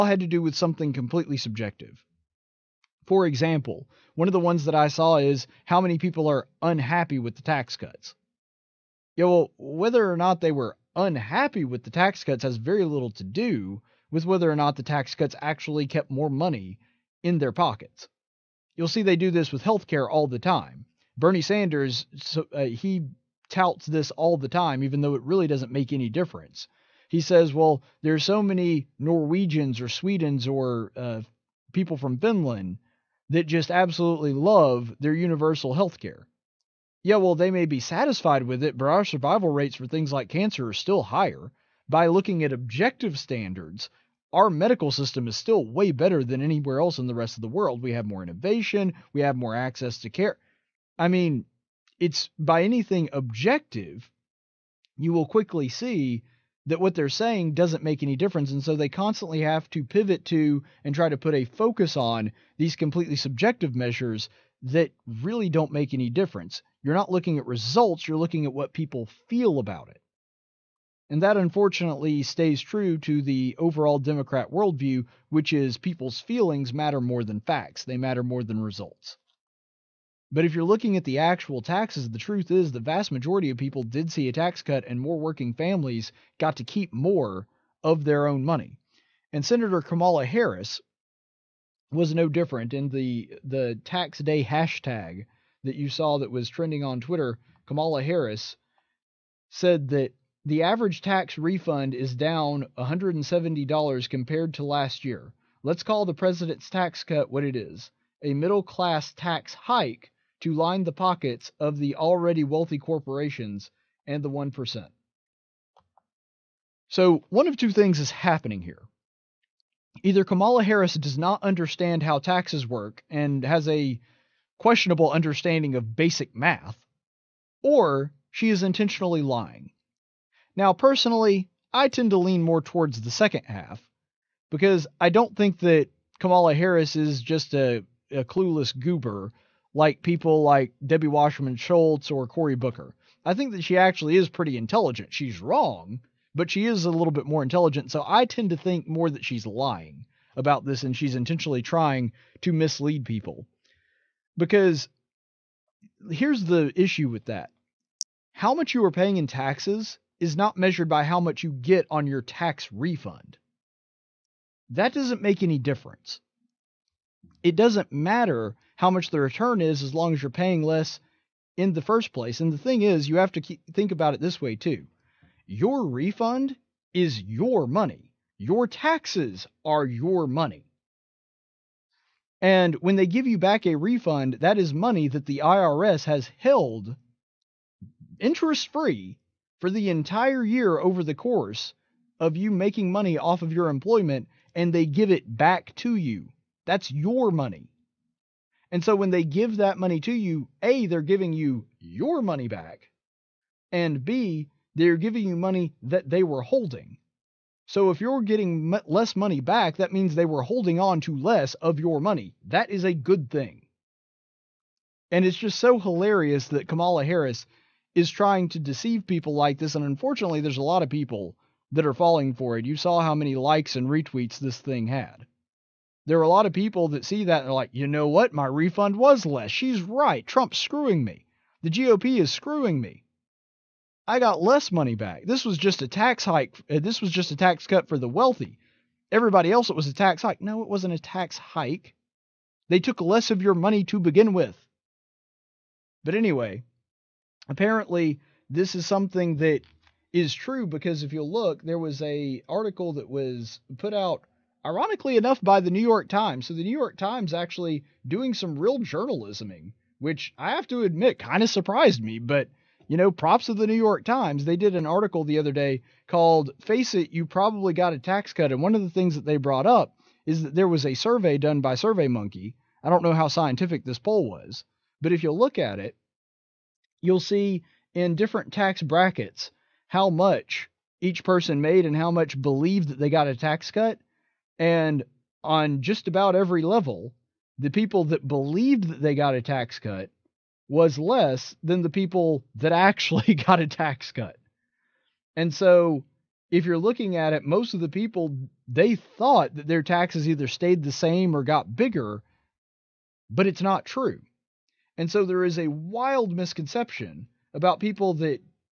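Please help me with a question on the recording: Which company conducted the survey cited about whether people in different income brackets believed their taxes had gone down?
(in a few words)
SurveyMonkey.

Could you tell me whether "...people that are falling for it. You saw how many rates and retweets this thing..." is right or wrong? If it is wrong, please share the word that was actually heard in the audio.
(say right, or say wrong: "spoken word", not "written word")
wrong: "likes", not "rates".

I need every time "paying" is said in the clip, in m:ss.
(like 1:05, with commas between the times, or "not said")
2:38, 2:50.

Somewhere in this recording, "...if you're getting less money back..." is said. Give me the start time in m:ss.
3:27.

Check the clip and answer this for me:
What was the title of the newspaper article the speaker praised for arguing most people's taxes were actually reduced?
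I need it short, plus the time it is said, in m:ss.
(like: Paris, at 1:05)
Face It, You Probably Got a Tax Cut, at 4:26.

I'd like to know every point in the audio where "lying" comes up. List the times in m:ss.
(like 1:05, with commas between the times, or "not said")
2:09, 2:29.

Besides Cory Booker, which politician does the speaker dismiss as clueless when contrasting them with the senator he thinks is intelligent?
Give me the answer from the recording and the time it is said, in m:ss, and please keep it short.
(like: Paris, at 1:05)
Debbie Wasserman Schultz, at 2:20.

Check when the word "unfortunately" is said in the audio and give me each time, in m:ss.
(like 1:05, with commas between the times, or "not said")
1:11, 3:39.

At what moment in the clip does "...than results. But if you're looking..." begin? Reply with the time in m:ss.
1:18.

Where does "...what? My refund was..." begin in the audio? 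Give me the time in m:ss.
3:48.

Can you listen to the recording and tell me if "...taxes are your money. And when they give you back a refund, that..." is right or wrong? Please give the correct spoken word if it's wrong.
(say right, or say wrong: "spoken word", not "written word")
right.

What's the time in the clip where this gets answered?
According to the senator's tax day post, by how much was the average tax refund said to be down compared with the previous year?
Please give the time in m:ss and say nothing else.
1:42.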